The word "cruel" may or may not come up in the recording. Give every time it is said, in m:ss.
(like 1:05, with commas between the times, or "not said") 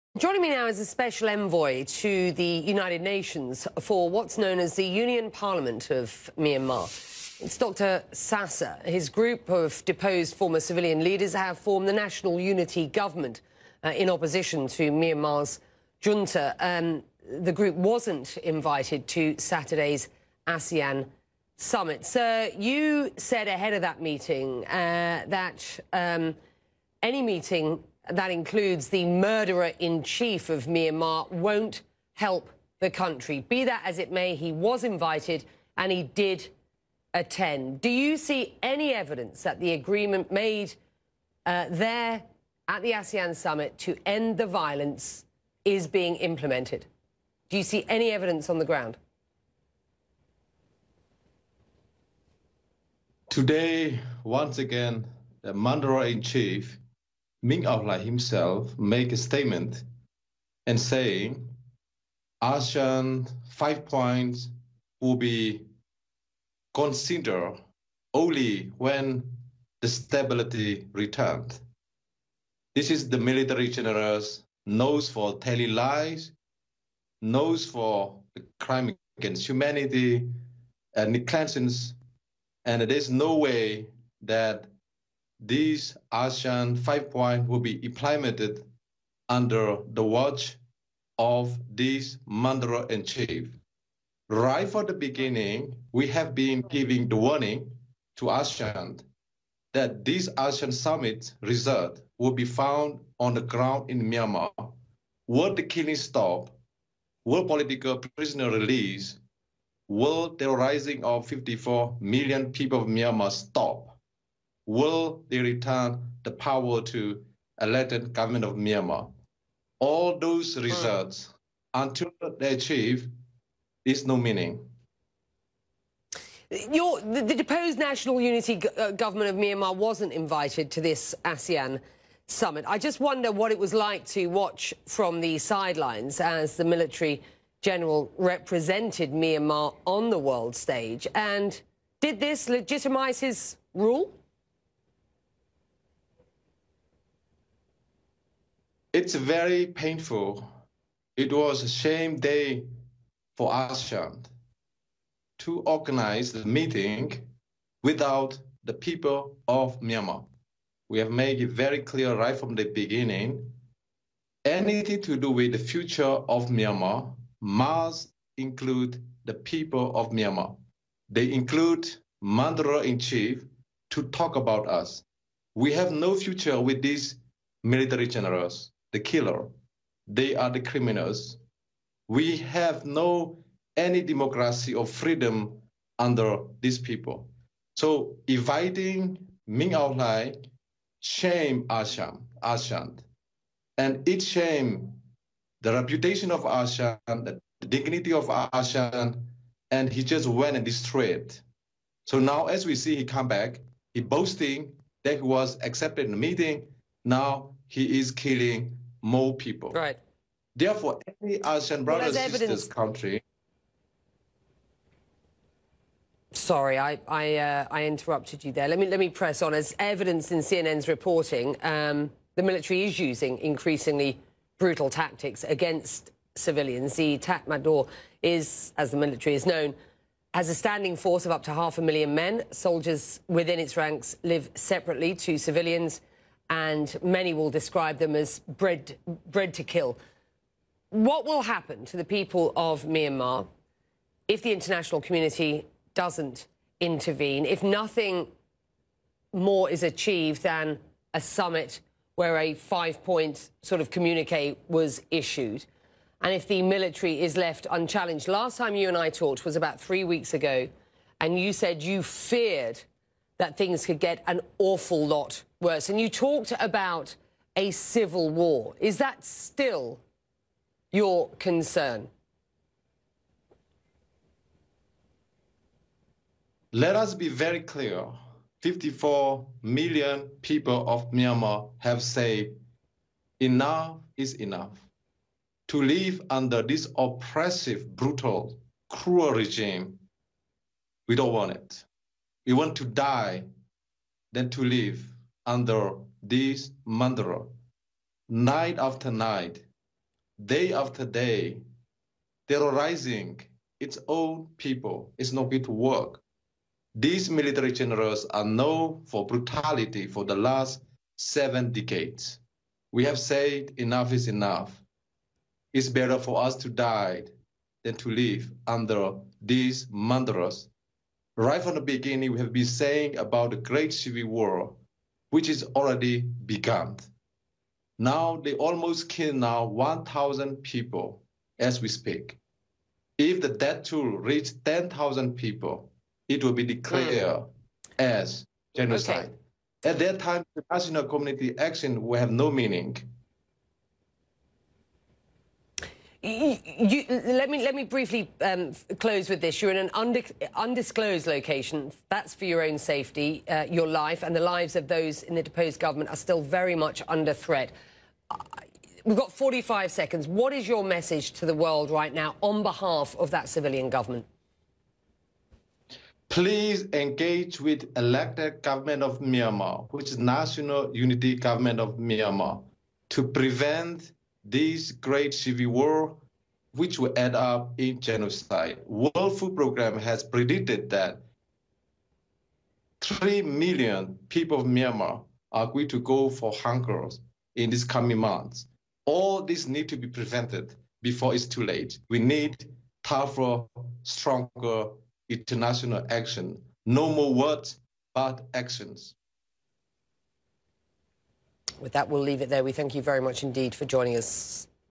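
4:48.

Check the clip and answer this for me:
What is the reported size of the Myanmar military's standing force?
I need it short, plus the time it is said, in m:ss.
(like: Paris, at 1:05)
half a million, at 3:51.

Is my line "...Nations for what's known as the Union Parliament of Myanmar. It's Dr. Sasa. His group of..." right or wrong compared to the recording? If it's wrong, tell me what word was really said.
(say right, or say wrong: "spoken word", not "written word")
right.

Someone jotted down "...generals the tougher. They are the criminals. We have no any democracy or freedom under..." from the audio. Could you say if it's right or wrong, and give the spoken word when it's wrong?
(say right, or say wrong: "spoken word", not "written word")
wrong: "killer", not "tougher".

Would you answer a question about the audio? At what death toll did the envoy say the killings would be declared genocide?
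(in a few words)
10,000.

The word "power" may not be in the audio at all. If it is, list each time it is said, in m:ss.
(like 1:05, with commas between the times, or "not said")
1:56.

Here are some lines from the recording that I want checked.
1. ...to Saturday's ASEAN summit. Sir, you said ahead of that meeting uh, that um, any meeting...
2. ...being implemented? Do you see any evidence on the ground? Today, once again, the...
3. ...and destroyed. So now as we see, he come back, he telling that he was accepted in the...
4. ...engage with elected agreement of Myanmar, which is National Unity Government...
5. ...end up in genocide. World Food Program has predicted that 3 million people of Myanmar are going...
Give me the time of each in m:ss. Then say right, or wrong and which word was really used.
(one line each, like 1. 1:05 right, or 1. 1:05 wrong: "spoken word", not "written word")
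1. 0:19 right
2. 0:45 right
3. 3:20 wrong: "boasting", not "telling"
4. 6:06 wrong: "government", not "agreement"
5. 6:17 right.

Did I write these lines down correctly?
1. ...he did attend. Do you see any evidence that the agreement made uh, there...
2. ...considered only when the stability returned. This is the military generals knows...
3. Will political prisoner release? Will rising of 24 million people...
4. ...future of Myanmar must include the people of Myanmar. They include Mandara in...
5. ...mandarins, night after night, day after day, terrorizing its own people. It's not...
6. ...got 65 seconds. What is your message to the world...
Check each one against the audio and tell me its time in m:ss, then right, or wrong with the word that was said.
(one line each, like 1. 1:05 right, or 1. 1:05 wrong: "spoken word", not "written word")
1. 0:35 right
2. 1:06 right
3. 1:47 wrong: "54", not "24"
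4. 2:45 right
5. 4:56 right
6. 5:59 wrong: "45", not "65".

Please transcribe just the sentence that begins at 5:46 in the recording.
You, let me let me briefly um, close with this.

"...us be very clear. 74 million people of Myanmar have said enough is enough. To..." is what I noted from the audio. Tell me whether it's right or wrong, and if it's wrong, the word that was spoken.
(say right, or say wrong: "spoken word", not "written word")
wrong: "54", not "74".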